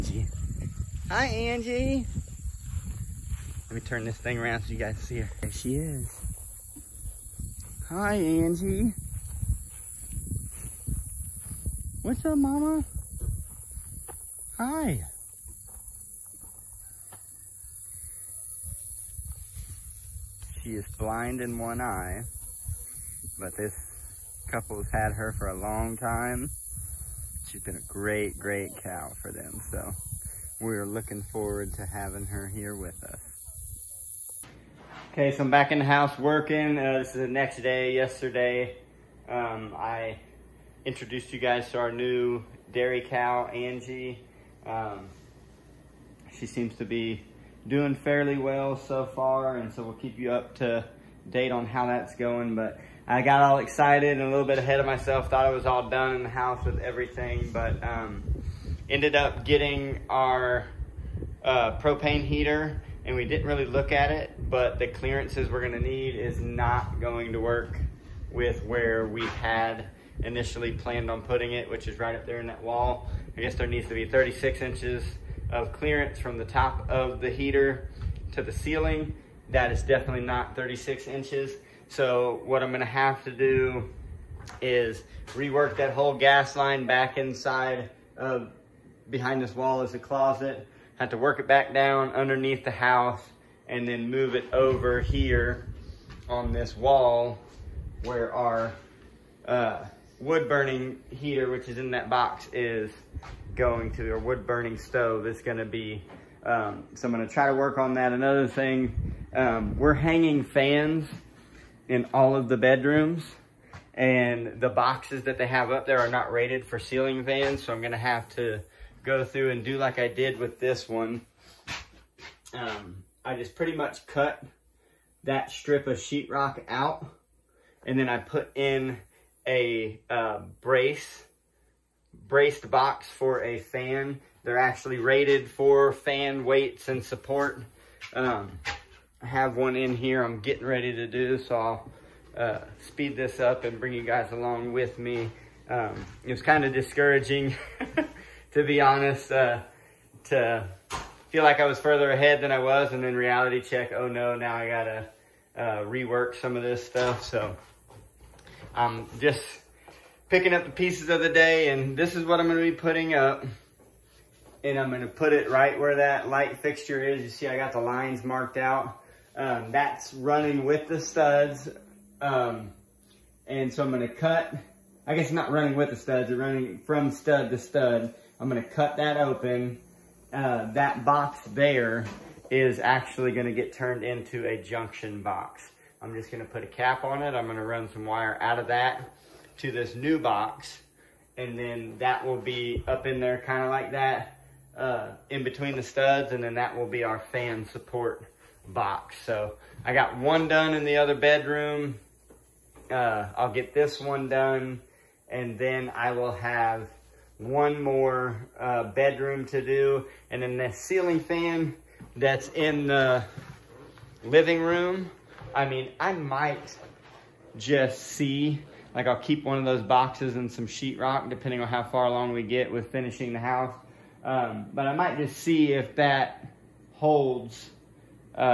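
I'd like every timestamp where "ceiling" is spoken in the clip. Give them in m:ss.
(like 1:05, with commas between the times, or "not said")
1:18, 1:56, 3:30.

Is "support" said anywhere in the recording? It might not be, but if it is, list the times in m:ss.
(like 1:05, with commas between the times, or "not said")
2:17, 3:17.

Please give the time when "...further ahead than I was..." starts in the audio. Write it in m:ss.
2:31.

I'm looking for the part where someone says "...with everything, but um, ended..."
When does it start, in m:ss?
0:56.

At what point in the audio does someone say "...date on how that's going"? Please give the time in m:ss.
0:51.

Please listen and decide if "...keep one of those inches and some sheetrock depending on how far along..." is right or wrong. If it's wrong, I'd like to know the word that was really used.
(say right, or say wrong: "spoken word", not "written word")
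wrong: "boxes", not "inches".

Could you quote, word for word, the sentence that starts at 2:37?
So I'm um, just picking up the pieces of the day and this is what I'm gonna be putting up.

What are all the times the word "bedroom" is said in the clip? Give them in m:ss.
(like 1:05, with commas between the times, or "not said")
1:52, 3:21, 3:28.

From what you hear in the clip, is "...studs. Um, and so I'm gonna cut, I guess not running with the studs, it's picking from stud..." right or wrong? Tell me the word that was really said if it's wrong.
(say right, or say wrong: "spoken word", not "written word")
wrong: "running", not "picking".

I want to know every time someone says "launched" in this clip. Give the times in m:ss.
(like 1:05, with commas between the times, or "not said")
not said.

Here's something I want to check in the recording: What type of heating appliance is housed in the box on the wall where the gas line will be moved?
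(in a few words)
wood burning stove.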